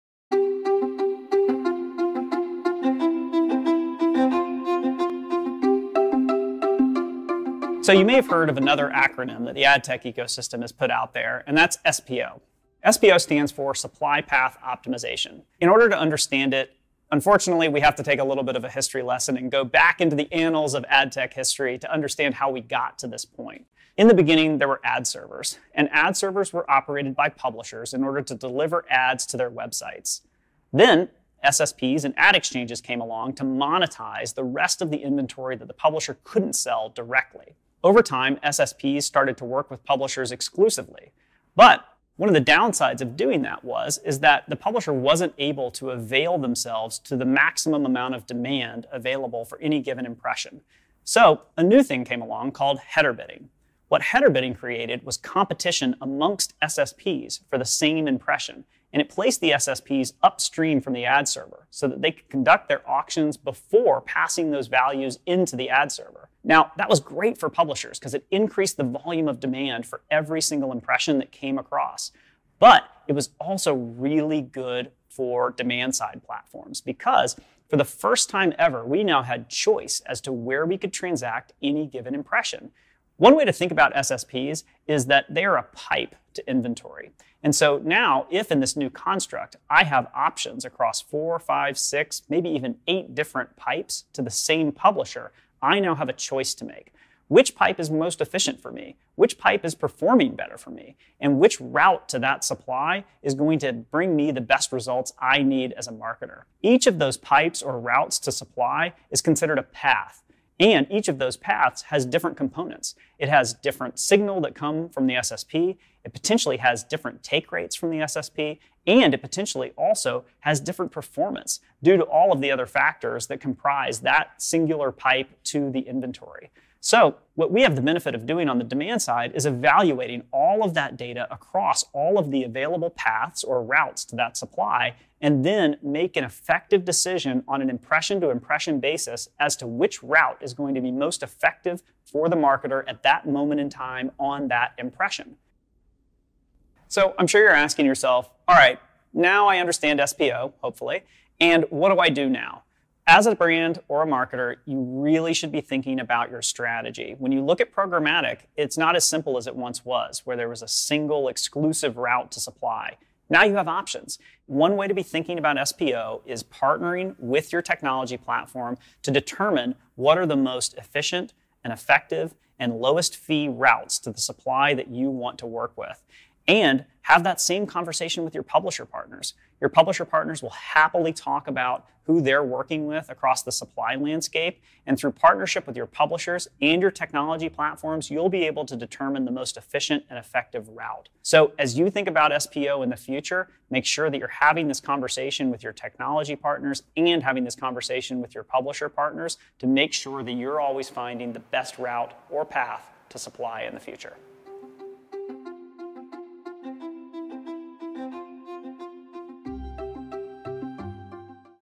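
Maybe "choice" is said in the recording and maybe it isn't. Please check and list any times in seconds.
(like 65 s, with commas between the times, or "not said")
79 s, 96 s.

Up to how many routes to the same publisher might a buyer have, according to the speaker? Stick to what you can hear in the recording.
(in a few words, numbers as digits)
8.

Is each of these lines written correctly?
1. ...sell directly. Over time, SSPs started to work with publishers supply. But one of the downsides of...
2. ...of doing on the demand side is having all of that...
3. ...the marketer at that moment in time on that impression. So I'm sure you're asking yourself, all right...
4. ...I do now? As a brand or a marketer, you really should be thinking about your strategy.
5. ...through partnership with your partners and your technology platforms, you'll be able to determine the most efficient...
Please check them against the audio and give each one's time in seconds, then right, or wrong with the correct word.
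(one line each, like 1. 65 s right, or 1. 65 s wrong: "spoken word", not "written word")
1. 36 s wrong: "exclusively", not "supply"
2. 128 s wrong: "evaluating", not "having"
3. 142 s right
4. 152 s right
5. 184 s wrong: "publishers", not "partners".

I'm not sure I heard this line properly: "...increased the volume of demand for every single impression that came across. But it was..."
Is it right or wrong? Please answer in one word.
right.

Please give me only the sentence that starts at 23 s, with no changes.
In the beginning, there were ad servers, and ad servers were operated by publishers in order to deliver ads to their websites.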